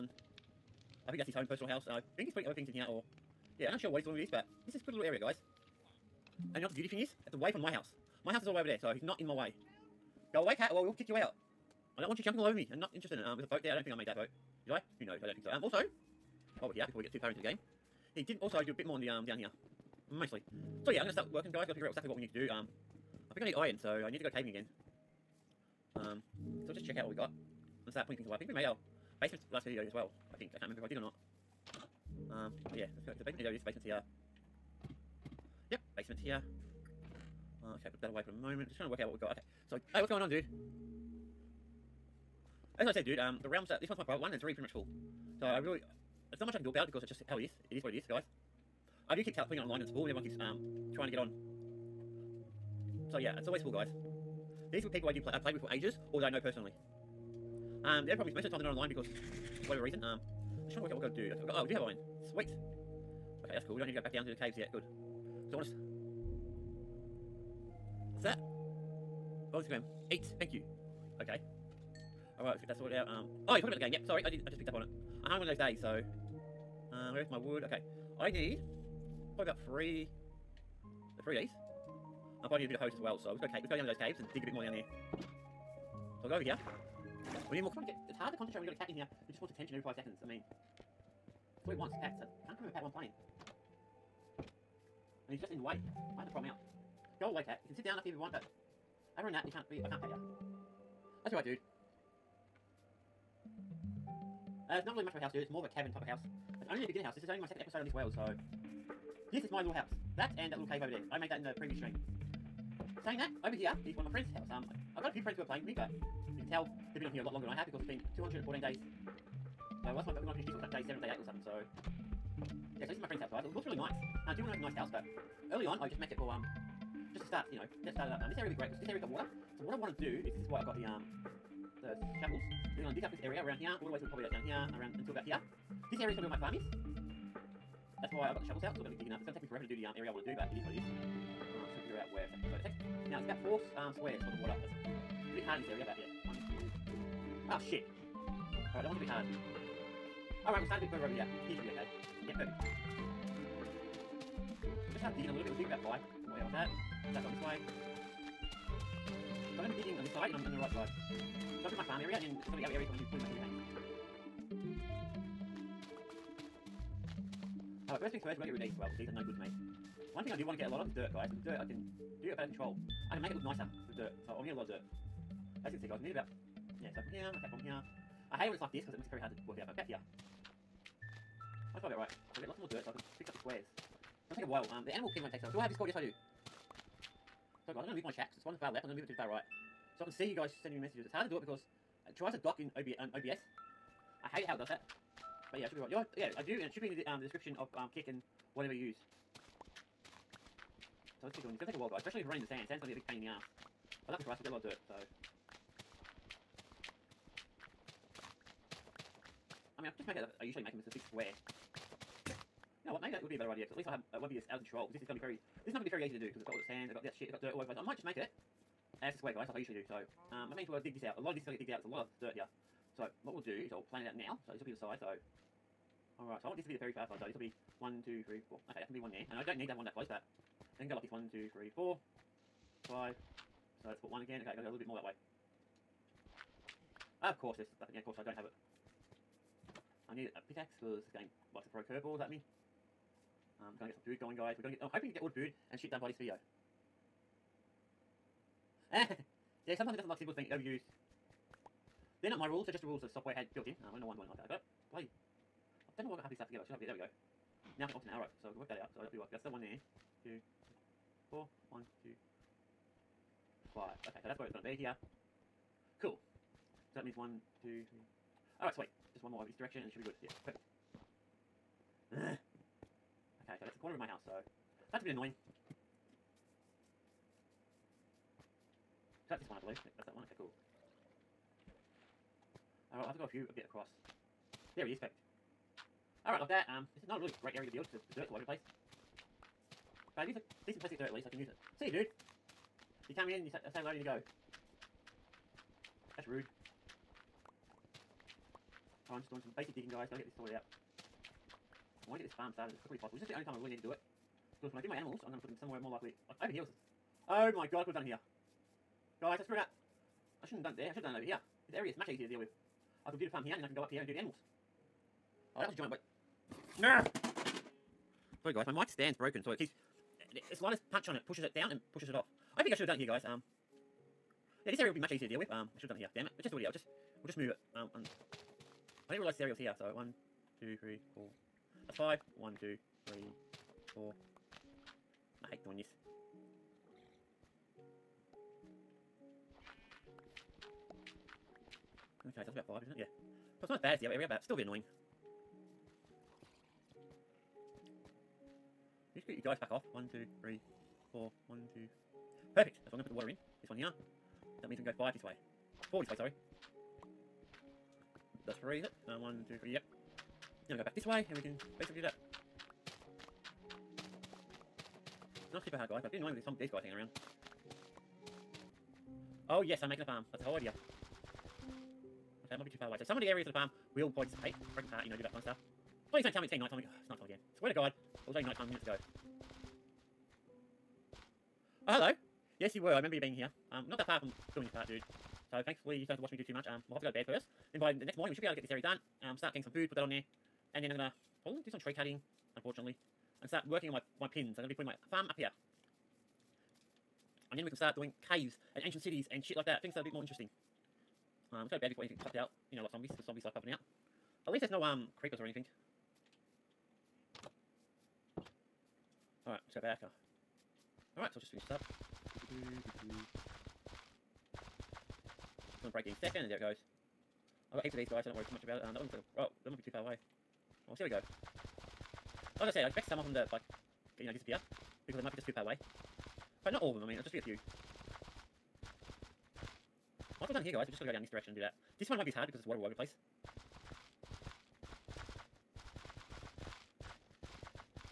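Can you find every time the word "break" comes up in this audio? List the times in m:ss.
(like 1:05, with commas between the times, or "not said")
6:14, 6:55.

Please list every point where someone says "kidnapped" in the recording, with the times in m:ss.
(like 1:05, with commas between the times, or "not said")
not said.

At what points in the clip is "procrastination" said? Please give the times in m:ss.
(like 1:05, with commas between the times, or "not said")
not said.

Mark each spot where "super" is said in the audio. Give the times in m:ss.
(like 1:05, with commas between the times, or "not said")
6:05.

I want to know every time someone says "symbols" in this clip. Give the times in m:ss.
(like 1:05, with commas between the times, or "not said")
4:10.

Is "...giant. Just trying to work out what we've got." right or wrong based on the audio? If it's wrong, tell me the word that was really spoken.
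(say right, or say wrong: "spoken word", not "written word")
wrong: "moment", not "giant".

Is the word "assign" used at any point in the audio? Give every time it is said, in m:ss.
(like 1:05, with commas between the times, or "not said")
not said.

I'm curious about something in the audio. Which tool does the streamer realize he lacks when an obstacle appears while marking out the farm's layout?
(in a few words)
pickaxe.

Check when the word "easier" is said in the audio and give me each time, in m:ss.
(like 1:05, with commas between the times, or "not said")
5:12, 5:25.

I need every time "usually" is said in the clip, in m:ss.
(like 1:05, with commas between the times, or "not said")
3:30, 3:39.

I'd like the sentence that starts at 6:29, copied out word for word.
Um, start getting some food, put that on there.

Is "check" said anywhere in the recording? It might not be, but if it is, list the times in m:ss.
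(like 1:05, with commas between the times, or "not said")
0:26, 3:08.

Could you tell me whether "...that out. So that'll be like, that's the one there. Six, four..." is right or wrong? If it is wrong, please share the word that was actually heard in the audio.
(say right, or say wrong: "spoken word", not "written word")
wrong: "Two", not "Six".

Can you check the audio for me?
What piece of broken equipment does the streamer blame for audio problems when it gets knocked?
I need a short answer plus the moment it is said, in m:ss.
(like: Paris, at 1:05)
mic stand, at 5:18.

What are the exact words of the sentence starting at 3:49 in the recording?
And I don't need to have one that close, but I can go like this.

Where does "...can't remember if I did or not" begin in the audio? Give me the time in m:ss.
0:30.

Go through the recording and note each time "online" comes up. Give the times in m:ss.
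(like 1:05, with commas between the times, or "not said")
0:49, 0:58.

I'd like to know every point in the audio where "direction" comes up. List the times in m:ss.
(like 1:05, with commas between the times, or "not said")
4:29, 7:11.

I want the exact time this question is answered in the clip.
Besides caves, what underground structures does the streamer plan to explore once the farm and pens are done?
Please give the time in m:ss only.
6:38.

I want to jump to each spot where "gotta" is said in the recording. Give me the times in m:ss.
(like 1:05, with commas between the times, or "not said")
3:54, 5:00.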